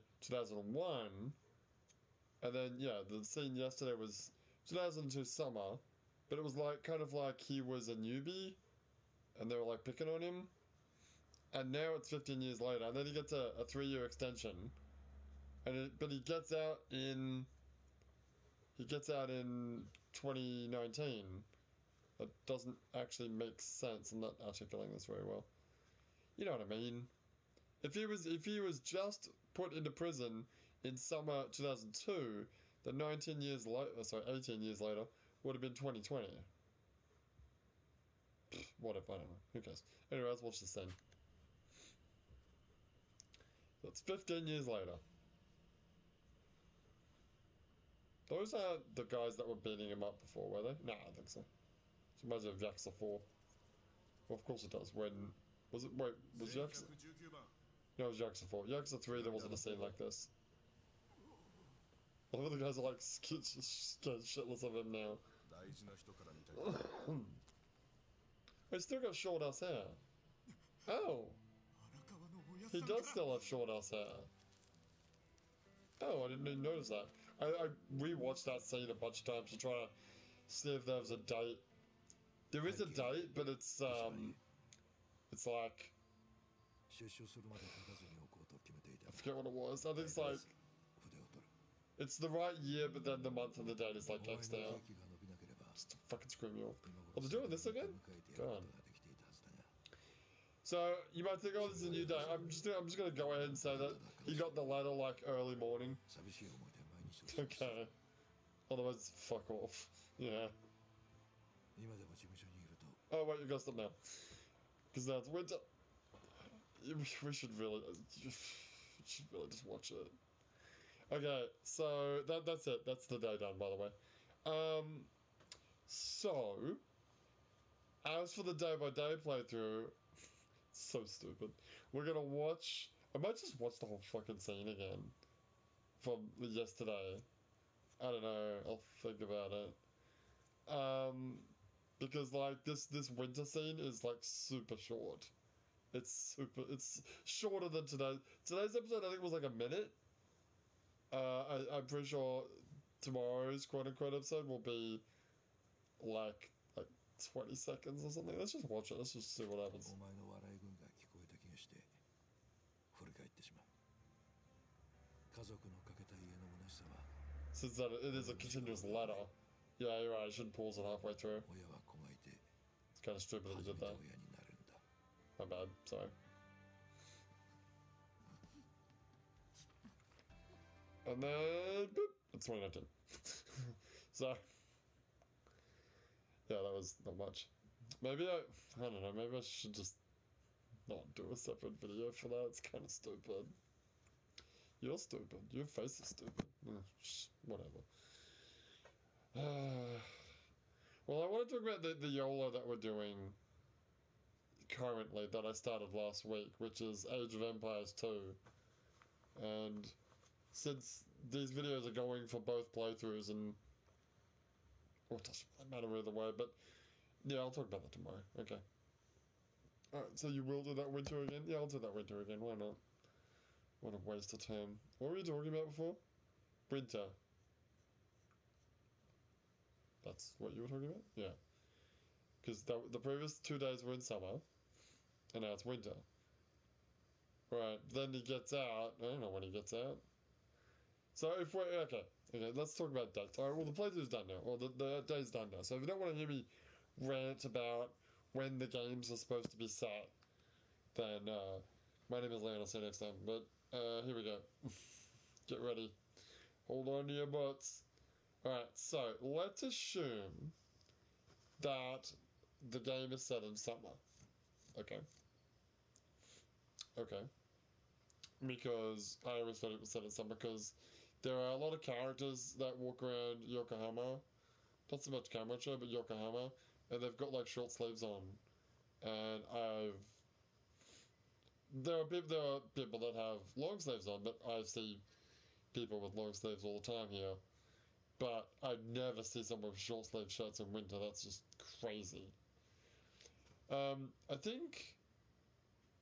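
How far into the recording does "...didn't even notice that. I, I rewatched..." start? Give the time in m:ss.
1:16.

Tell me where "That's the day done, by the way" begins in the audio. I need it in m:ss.
2:02.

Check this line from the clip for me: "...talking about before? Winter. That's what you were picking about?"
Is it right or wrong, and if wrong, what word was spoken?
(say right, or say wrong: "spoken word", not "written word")
wrong: "talking", not "picking".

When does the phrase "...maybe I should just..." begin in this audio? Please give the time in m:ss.
3:09.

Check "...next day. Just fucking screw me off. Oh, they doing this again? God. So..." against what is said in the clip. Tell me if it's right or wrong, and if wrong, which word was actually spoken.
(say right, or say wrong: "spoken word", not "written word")
right.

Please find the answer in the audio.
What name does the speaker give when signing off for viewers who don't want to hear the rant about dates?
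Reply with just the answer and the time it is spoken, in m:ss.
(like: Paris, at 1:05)
Leon, at 4:12.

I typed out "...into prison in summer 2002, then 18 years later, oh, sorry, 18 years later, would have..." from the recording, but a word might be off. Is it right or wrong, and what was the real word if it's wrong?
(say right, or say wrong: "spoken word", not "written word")
wrong: "19", not "18".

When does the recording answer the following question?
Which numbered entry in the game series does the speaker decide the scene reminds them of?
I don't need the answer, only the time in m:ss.
0:58.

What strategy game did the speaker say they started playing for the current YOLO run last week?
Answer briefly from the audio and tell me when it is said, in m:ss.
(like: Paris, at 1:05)
Age of Empires 2, at 3:27.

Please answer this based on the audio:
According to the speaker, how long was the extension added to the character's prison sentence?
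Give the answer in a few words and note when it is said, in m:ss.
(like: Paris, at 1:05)
3 years, at 0:13.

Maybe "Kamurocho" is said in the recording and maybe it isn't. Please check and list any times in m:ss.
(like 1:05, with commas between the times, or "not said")
4:35.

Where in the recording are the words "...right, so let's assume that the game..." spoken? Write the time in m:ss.
4:18.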